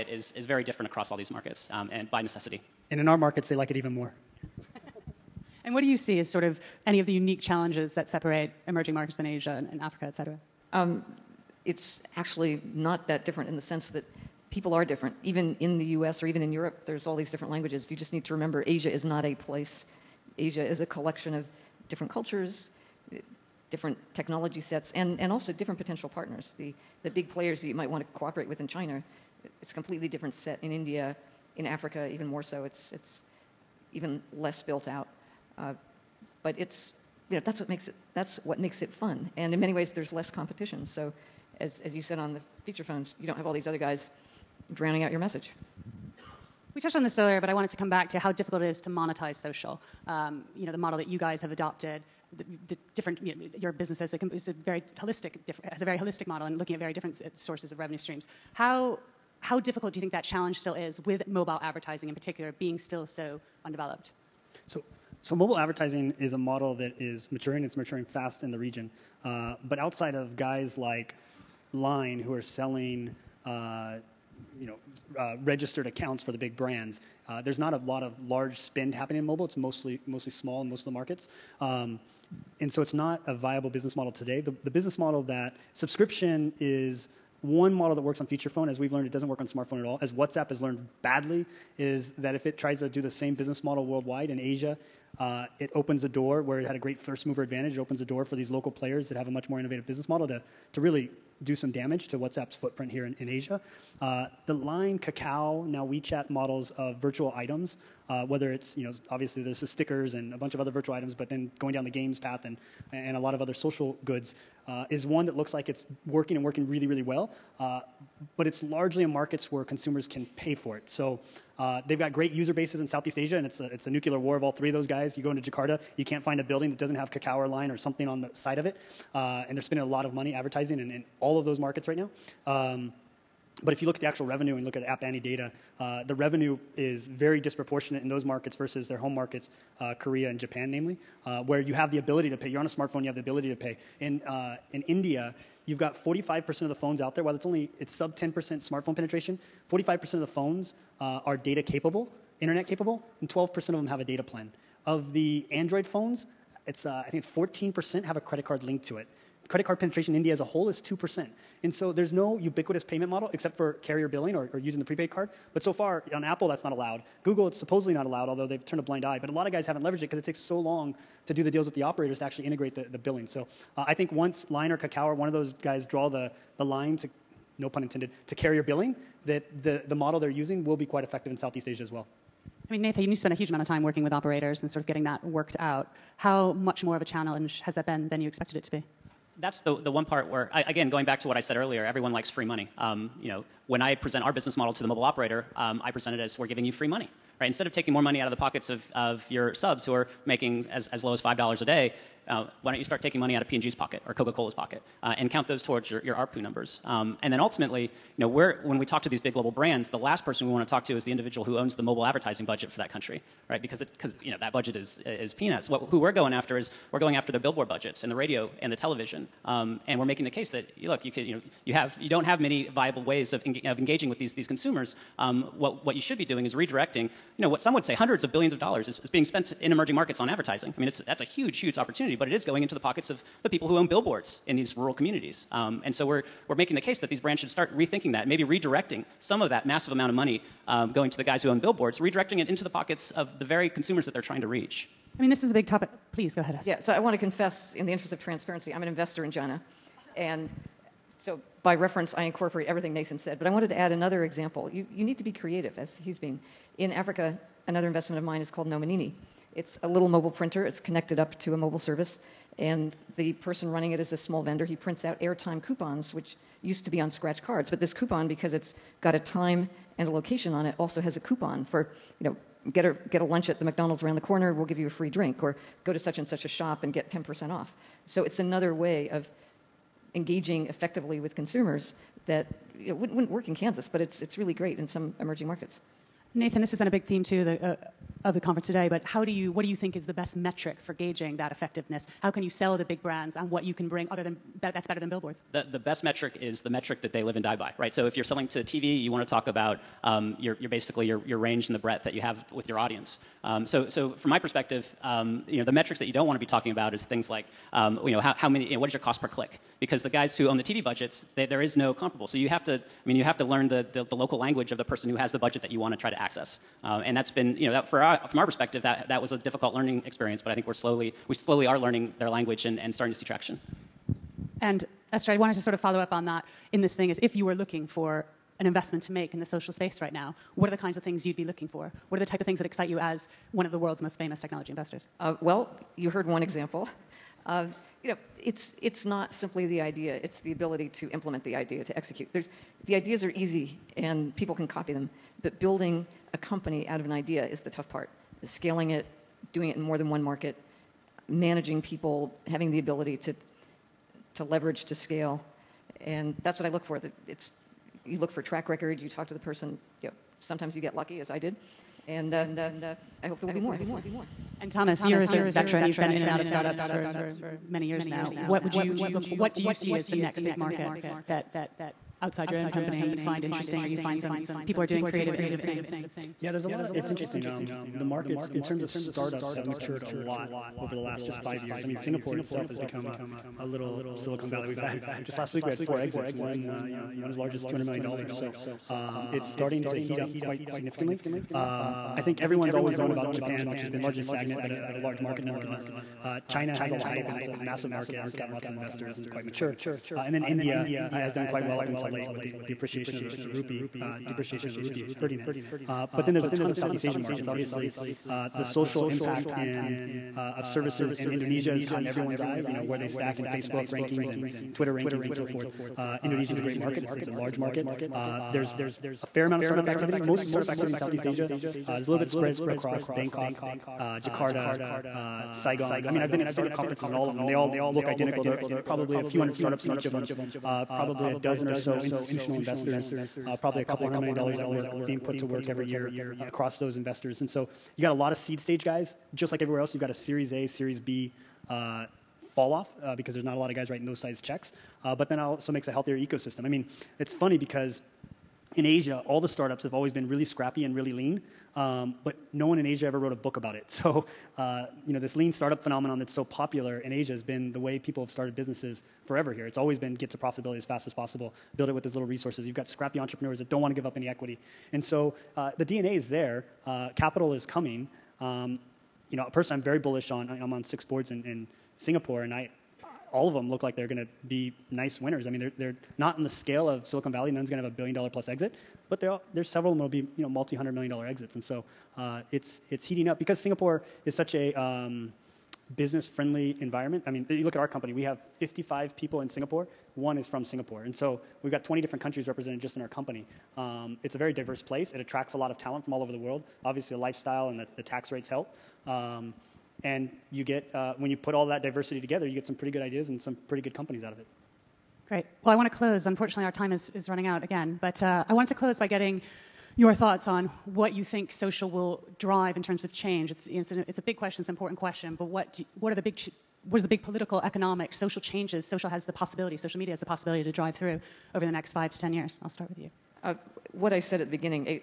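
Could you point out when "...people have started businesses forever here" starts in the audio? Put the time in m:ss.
7:37.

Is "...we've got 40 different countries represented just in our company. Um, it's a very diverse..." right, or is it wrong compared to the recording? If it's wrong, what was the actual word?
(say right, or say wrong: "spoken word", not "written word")
wrong: "20", not "40".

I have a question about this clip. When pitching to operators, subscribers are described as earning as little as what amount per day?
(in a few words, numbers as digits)
$5.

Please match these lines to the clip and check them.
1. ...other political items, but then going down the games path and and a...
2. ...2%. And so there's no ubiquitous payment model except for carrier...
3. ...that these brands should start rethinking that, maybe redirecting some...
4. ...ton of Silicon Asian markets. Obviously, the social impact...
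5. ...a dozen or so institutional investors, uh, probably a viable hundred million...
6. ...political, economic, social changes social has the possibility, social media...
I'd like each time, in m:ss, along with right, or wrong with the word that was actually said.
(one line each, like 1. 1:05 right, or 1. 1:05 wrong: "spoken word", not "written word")
1. 1:50 wrong: "virtual", not "political"
2. 2:40 right
3. 3:56 right
4. 6:46 wrong: "Southeast", not "Silicon"
5. 7:11 wrong: "couple", not "viable"
6. 8:37 right.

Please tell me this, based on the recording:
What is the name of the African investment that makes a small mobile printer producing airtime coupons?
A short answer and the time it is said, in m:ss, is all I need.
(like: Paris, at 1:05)
Nomanini, at 4:18.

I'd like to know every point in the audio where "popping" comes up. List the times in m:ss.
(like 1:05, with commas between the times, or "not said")
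not said.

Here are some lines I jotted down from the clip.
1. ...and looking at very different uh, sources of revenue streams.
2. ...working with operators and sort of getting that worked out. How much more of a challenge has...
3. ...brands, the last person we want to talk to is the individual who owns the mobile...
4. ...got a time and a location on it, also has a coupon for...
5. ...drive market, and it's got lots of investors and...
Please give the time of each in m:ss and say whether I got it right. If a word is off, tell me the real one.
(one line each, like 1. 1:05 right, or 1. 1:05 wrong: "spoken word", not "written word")
1. 0:56 right
2. 3:03 right
3. 3:29 right
4. 4:29 right
5. 6:37 wrong: "massive", not "drive".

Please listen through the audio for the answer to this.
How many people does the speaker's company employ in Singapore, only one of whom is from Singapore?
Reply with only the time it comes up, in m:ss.
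8:08.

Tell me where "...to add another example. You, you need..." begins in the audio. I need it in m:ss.
4:13.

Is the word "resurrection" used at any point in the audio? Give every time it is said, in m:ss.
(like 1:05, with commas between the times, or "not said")
not said.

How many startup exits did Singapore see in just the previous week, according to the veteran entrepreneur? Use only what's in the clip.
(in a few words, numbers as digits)
4.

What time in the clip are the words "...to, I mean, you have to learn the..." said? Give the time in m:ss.
5:12.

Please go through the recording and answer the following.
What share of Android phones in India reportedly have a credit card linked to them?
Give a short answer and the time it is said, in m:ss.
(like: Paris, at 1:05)
14%, at 2:37.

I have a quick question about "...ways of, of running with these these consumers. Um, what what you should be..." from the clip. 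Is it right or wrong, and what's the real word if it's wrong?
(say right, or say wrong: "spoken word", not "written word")
wrong: "engaging", not "running".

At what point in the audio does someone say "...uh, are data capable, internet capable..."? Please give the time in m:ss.
2:31.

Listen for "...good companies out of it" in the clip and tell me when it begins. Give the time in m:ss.
8:23.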